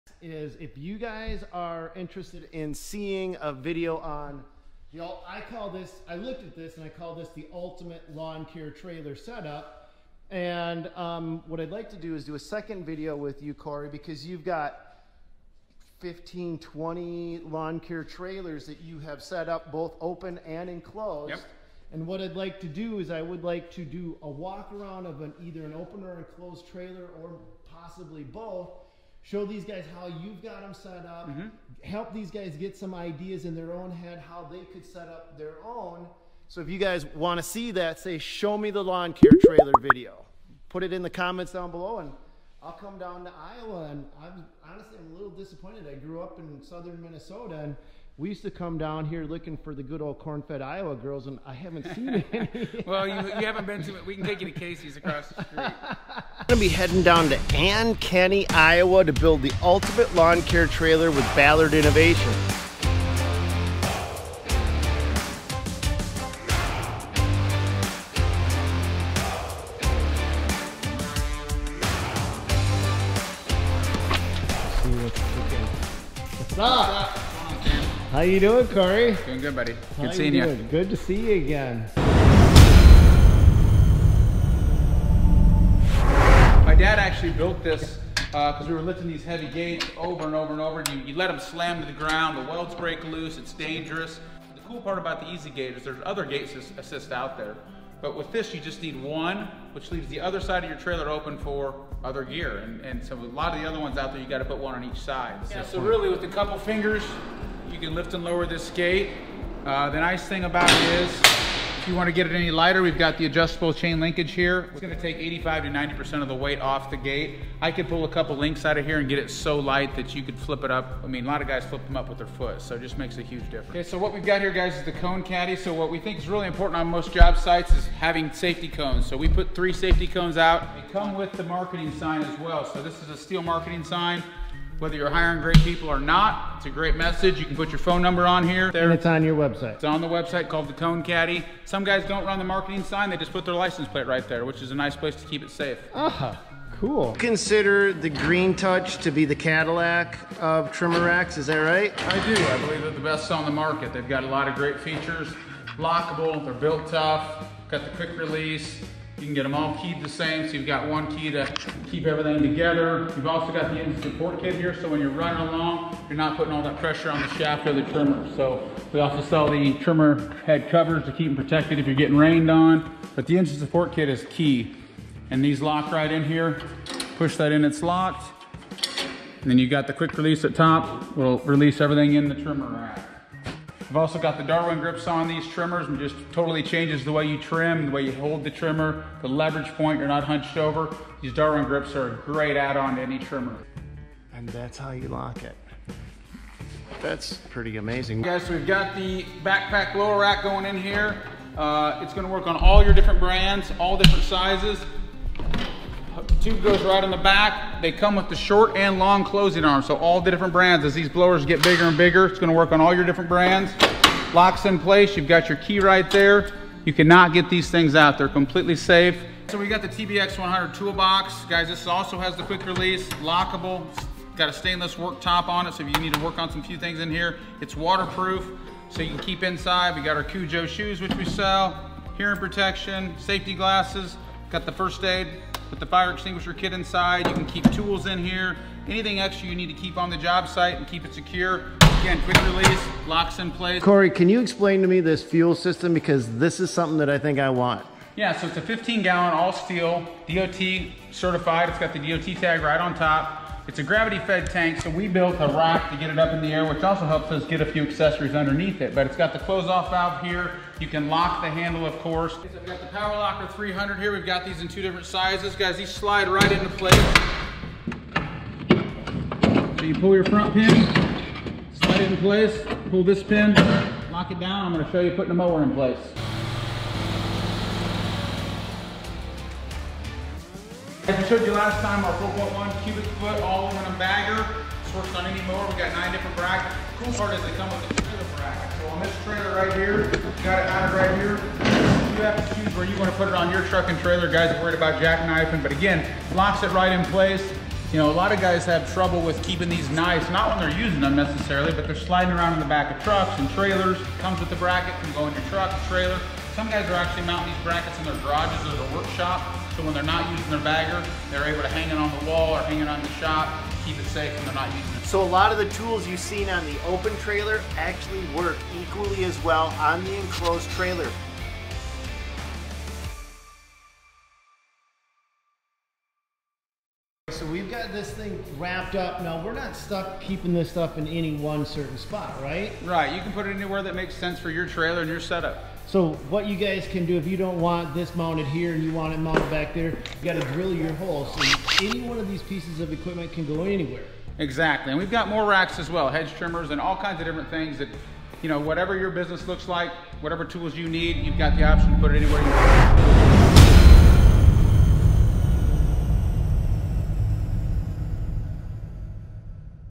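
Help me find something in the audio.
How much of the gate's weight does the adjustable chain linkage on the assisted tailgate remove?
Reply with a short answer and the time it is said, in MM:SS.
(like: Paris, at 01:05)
85 to 90%, at 01:55.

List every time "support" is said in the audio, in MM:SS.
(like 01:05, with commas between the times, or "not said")
02:44, 02:53.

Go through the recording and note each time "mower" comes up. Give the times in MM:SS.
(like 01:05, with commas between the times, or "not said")
04:35, 04:45.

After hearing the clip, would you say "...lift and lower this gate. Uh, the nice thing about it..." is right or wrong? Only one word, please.
right.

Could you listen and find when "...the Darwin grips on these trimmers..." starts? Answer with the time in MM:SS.
03:04.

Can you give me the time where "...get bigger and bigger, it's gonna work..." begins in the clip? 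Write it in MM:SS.
03:31.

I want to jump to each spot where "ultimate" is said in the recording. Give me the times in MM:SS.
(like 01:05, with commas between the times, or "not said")
00:07, 00:59.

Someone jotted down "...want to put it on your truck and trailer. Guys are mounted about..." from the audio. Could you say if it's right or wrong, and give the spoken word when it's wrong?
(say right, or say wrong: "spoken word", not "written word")
wrong: "worried", not "mounted".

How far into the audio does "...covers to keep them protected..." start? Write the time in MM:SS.
02:50.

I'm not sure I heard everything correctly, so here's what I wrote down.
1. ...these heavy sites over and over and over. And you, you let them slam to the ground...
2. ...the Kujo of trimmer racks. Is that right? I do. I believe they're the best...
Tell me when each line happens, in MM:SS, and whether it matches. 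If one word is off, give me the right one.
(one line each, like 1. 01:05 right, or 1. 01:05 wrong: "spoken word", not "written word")
1. 01:29 wrong: "gates", not "sites"
2. 02:29 wrong: "Cadillac", not "Kujo".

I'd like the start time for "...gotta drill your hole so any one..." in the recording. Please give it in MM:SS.
05:40.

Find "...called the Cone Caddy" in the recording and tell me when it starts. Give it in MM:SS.
02:20.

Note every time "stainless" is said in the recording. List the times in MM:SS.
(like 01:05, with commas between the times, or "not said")
03:44.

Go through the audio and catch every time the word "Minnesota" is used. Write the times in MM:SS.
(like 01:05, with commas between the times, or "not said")
00:47.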